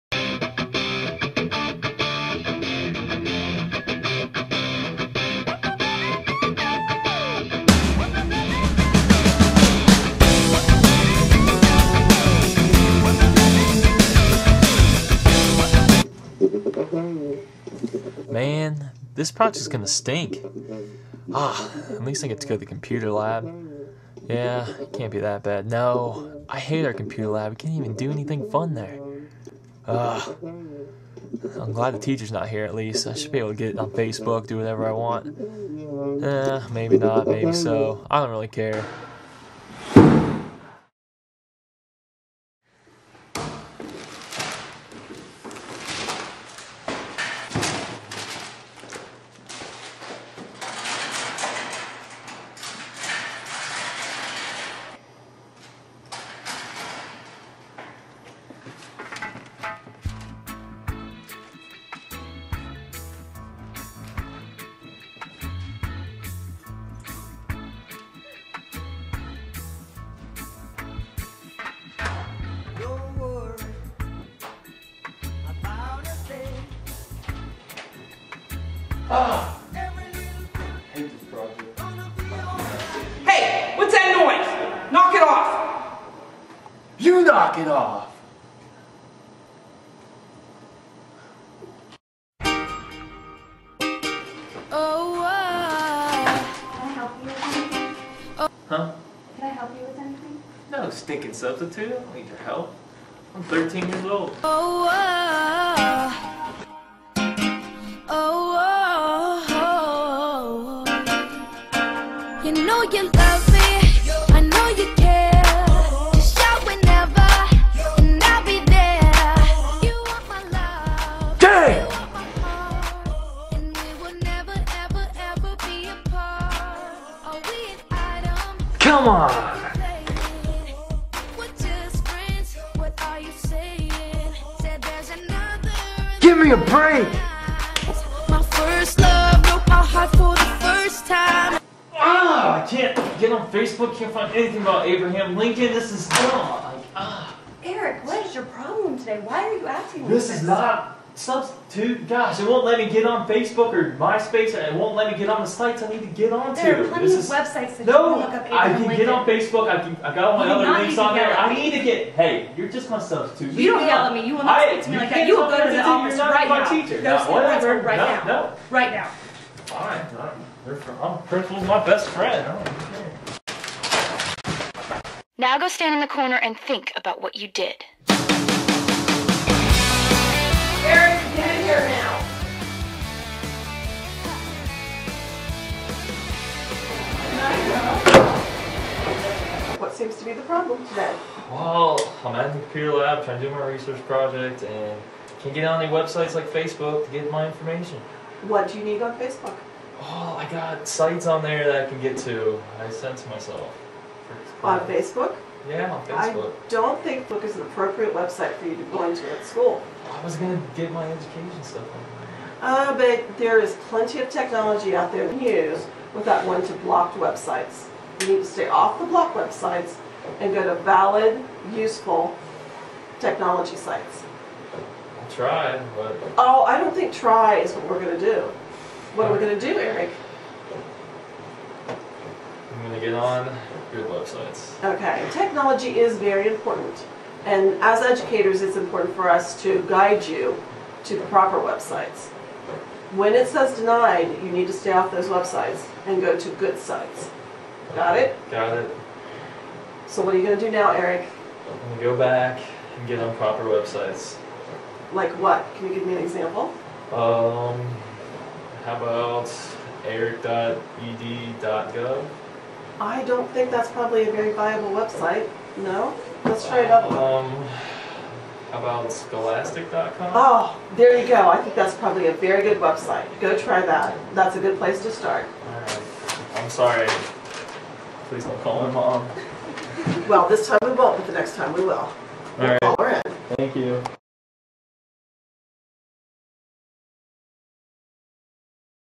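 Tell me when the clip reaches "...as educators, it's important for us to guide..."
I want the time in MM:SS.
03:57.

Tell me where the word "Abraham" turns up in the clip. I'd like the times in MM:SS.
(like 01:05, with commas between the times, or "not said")
02:24, 02:38.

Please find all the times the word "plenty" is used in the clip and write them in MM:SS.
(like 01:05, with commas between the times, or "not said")
02:36, 03:33.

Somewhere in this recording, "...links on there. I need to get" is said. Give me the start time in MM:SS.
02:40.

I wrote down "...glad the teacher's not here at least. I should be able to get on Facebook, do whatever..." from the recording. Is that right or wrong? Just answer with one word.
right.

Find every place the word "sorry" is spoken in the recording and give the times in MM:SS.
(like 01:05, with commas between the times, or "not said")
04:36.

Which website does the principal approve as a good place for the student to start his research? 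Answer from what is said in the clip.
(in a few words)
scholastic.com.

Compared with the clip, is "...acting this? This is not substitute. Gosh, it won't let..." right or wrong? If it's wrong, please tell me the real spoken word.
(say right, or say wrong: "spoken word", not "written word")
right.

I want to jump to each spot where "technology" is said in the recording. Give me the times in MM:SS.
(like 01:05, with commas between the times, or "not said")
03:34, 03:43, 03:55.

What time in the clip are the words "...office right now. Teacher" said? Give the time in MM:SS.
02:45.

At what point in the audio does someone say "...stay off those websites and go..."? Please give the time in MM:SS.
04:04.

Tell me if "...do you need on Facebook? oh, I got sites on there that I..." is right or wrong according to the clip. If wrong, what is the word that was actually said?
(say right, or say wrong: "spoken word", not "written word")
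right.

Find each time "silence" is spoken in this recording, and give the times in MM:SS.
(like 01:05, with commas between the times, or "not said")
not said.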